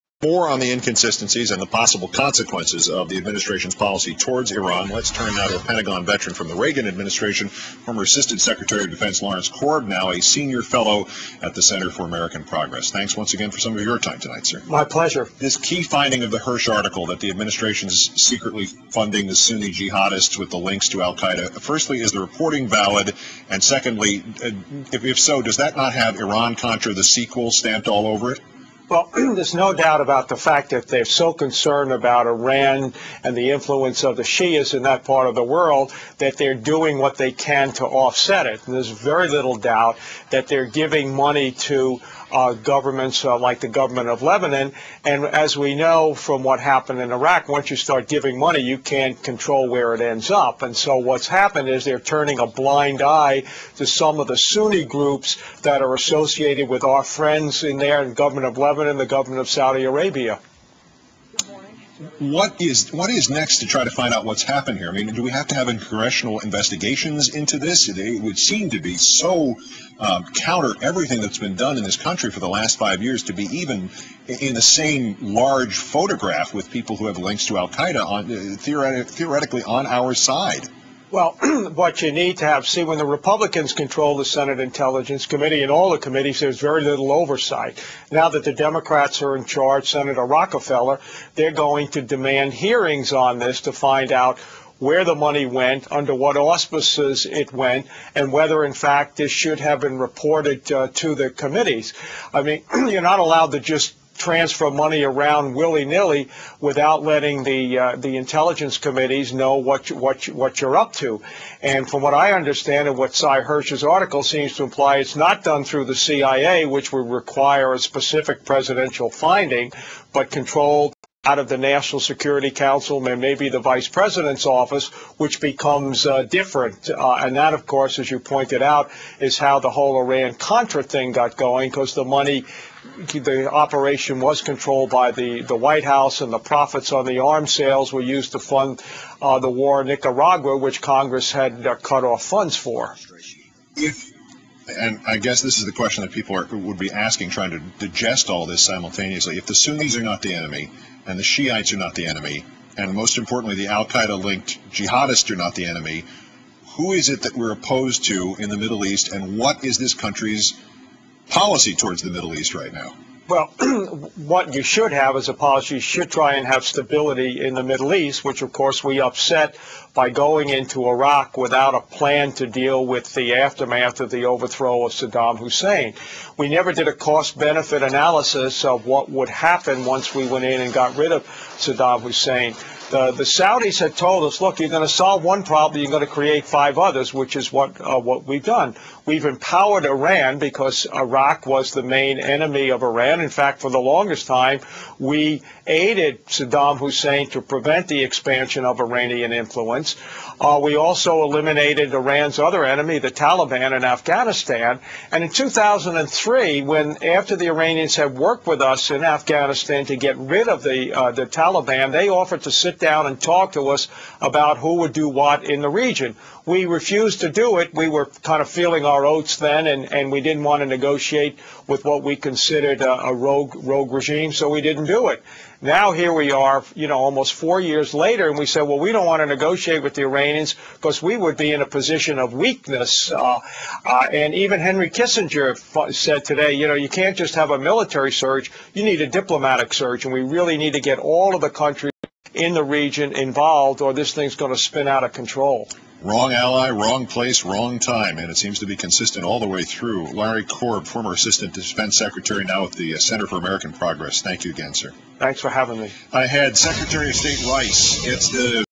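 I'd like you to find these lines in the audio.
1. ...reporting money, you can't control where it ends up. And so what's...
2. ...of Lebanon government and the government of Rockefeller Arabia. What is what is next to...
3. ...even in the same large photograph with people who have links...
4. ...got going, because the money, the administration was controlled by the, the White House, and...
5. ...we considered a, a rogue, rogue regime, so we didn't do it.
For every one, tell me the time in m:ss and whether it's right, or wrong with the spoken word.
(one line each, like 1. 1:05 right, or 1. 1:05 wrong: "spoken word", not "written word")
1. 0:48 wrong: "giving", not "reporting"
2. 0:58 wrong: "Saudi", not "Rockefeller"
3. 1:13 right
4. 2:11 wrong: "operation", not "administration"
5. 3:42 right.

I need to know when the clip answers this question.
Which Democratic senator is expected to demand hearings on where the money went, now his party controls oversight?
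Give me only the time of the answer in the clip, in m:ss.
1:29.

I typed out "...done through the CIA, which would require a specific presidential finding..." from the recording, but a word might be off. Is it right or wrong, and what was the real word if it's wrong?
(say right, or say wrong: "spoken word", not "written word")
right.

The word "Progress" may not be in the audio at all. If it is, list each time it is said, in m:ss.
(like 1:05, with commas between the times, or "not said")
0:12, 4:13.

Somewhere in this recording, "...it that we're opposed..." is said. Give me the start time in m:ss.
2:37.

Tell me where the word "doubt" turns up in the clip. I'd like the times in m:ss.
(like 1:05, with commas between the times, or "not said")
0:29, 0:39.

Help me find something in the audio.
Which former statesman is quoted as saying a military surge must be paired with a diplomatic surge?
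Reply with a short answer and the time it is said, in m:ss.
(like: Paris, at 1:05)
Henry Kissinger, at 3:54.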